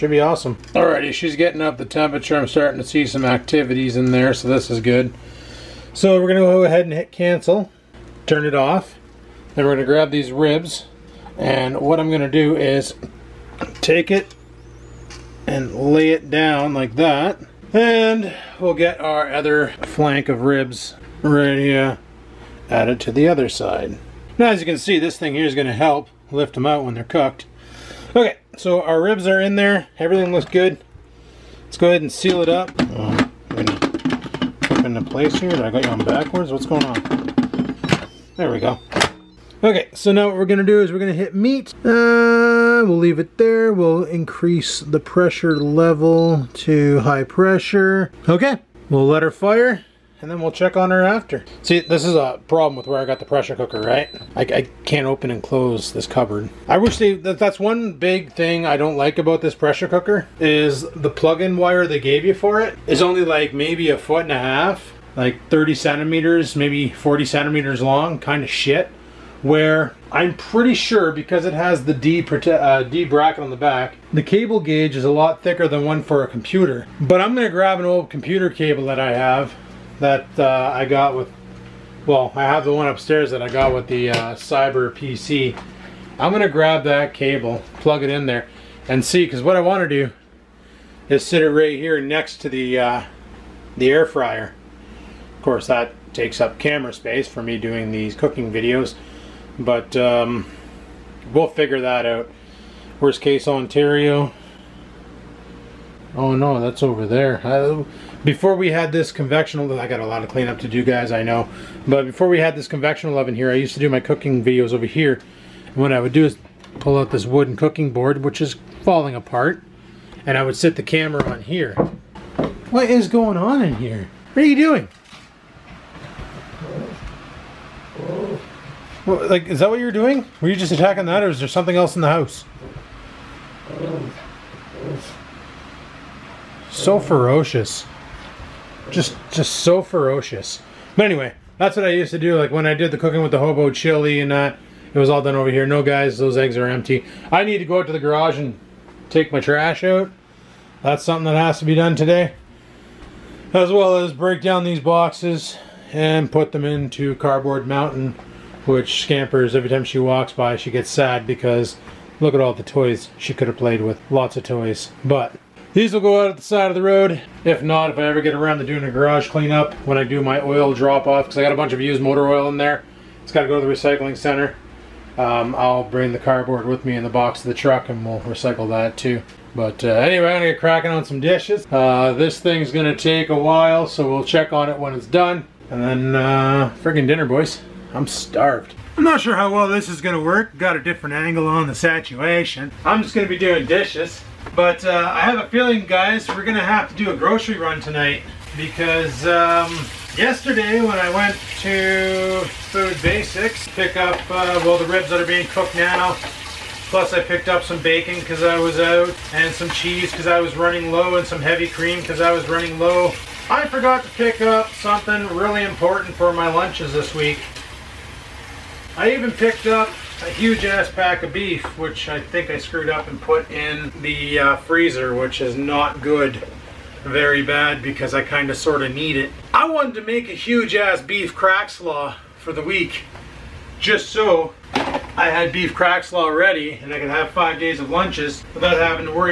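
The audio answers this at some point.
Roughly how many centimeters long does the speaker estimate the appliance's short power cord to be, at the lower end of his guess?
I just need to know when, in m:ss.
1:05.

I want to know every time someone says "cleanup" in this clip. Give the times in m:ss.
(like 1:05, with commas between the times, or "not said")
1:50, 2:49.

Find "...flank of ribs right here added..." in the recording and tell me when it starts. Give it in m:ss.
0:19.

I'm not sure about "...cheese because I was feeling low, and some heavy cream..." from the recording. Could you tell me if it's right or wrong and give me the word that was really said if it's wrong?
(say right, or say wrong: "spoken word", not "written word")
wrong: "running", not "feeling".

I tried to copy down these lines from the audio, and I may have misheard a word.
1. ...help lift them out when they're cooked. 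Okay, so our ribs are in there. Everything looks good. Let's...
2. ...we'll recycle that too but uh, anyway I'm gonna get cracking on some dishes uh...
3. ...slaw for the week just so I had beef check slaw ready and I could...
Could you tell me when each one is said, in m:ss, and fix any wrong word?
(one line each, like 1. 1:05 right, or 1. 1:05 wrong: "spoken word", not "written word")
1. 0:25 right
2. 2:58 right
3. 3:51 wrong: "crack", not "check".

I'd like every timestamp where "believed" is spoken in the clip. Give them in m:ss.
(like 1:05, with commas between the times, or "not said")
not said.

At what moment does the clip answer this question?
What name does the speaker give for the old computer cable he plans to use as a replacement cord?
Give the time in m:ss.
1:24.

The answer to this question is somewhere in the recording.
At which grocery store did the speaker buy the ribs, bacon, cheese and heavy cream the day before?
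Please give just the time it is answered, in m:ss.
3:22.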